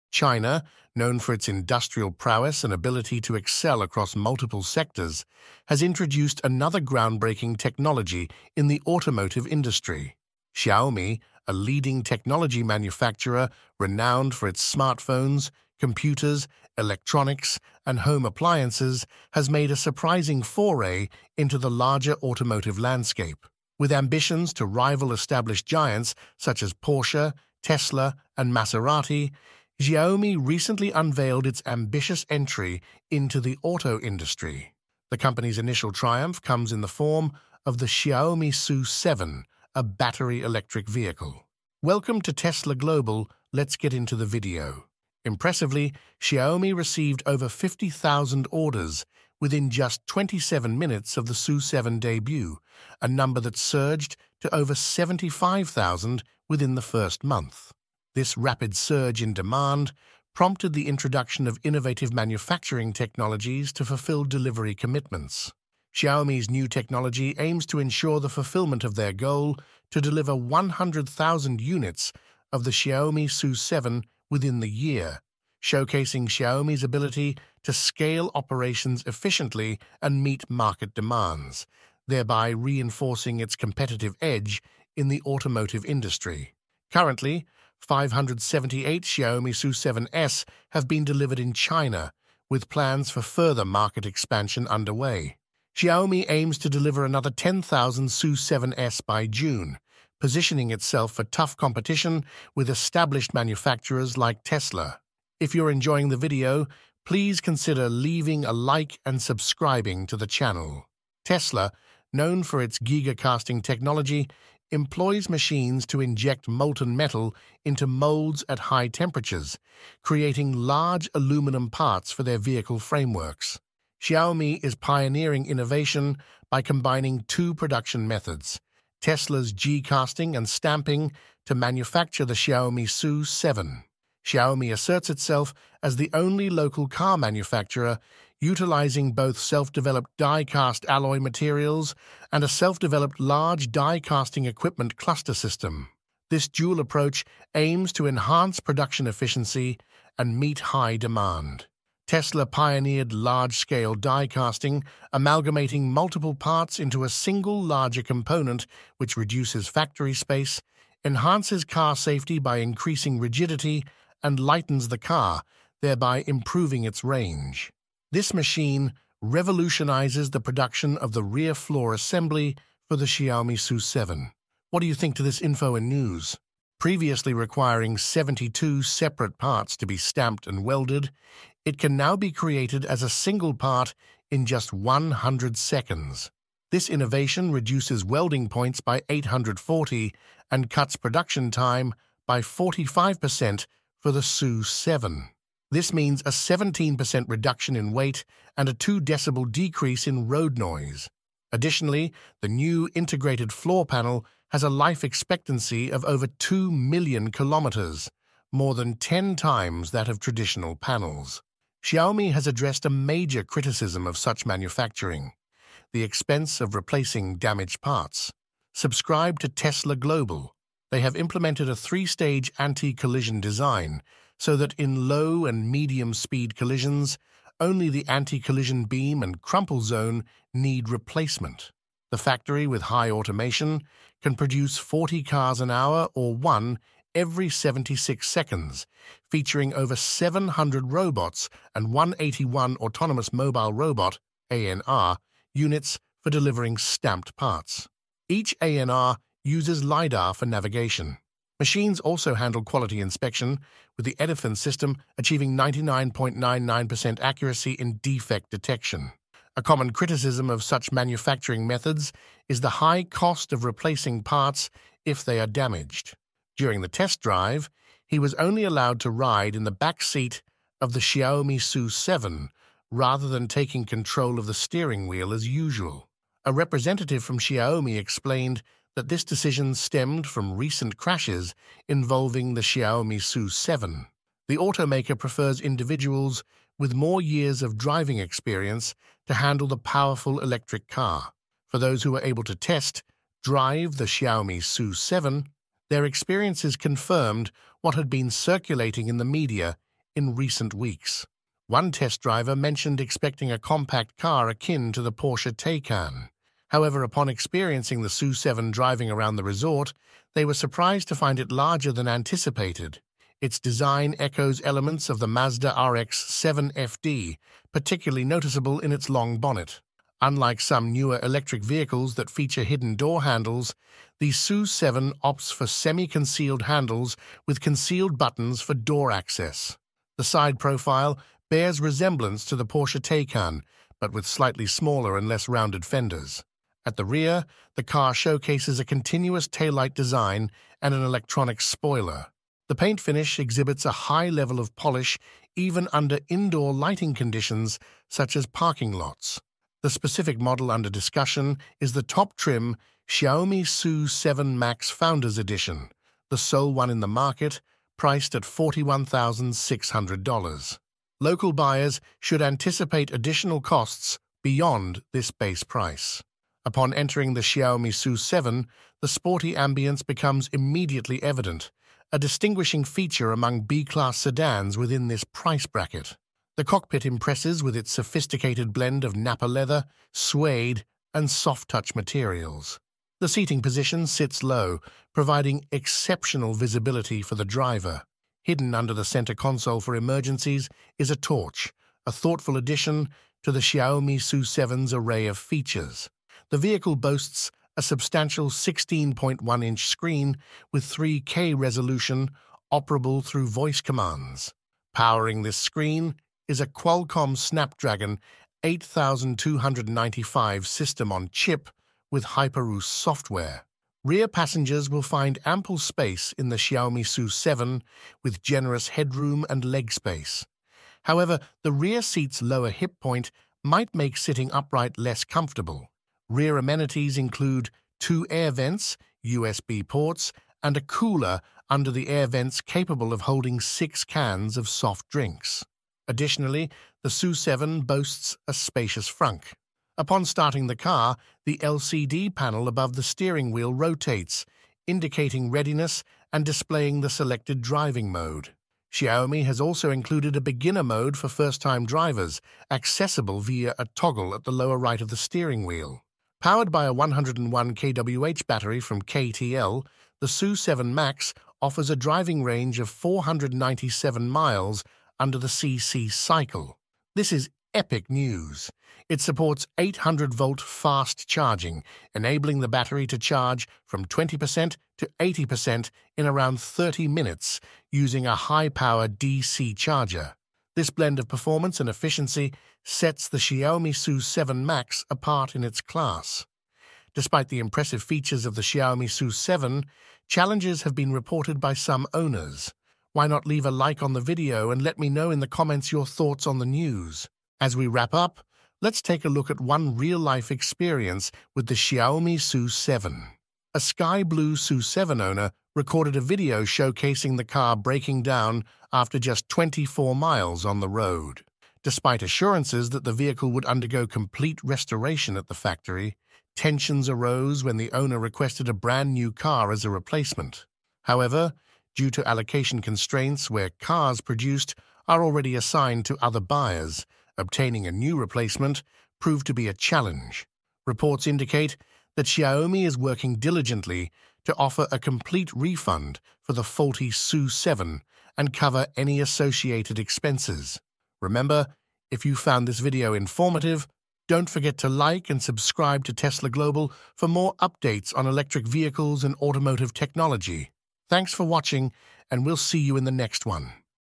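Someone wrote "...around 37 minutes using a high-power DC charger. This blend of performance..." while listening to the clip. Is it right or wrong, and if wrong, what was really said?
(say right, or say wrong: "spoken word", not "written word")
wrong: "30", not "37".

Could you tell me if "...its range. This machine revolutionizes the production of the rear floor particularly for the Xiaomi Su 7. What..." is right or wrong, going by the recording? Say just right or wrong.
wrong.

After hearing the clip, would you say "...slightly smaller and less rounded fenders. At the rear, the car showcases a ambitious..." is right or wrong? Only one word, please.
wrong.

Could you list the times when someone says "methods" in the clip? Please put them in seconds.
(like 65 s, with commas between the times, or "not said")
128 s, 261 s.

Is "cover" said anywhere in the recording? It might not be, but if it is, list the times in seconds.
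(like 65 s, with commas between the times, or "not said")
538 s.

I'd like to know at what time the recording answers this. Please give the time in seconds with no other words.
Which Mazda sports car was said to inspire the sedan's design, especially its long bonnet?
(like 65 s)
315 s.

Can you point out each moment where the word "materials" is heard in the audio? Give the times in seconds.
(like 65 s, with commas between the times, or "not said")
141 s, 381 s.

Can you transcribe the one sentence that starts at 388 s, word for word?
Hidden under the center console for emergencies is a torch, a thoughtful addition to the Xiaomi Su 7's array of features.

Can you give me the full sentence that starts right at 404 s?
Powering this screen is a Qualcomm Snapdragon 8295 system on chip with HyperOS software.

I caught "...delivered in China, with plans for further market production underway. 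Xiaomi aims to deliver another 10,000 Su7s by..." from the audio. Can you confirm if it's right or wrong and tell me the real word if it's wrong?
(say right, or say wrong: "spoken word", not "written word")
wrong: "expansion", not "production".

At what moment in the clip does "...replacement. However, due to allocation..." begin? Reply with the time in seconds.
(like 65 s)
519 s.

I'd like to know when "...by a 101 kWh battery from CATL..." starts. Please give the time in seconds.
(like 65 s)
456 s.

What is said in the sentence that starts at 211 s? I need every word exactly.
Xiaomi has addressed a major criticism of such manufacturing, the expense of replacing damaged parts.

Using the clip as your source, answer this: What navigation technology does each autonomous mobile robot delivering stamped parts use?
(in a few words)
LiDAR.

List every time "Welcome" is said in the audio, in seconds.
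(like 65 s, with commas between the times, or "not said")
41 s.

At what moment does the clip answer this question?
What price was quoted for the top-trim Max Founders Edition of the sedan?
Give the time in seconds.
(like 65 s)
358 s.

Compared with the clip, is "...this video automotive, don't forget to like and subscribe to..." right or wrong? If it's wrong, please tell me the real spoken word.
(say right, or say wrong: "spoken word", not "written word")
wrong: "informative", not "automotive".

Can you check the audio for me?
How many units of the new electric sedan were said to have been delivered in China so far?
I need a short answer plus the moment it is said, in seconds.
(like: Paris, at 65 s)
578, at 87 s.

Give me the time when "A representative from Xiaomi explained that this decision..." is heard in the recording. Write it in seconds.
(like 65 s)
276 s.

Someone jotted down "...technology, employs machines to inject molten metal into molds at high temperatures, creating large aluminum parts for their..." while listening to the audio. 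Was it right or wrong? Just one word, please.
right.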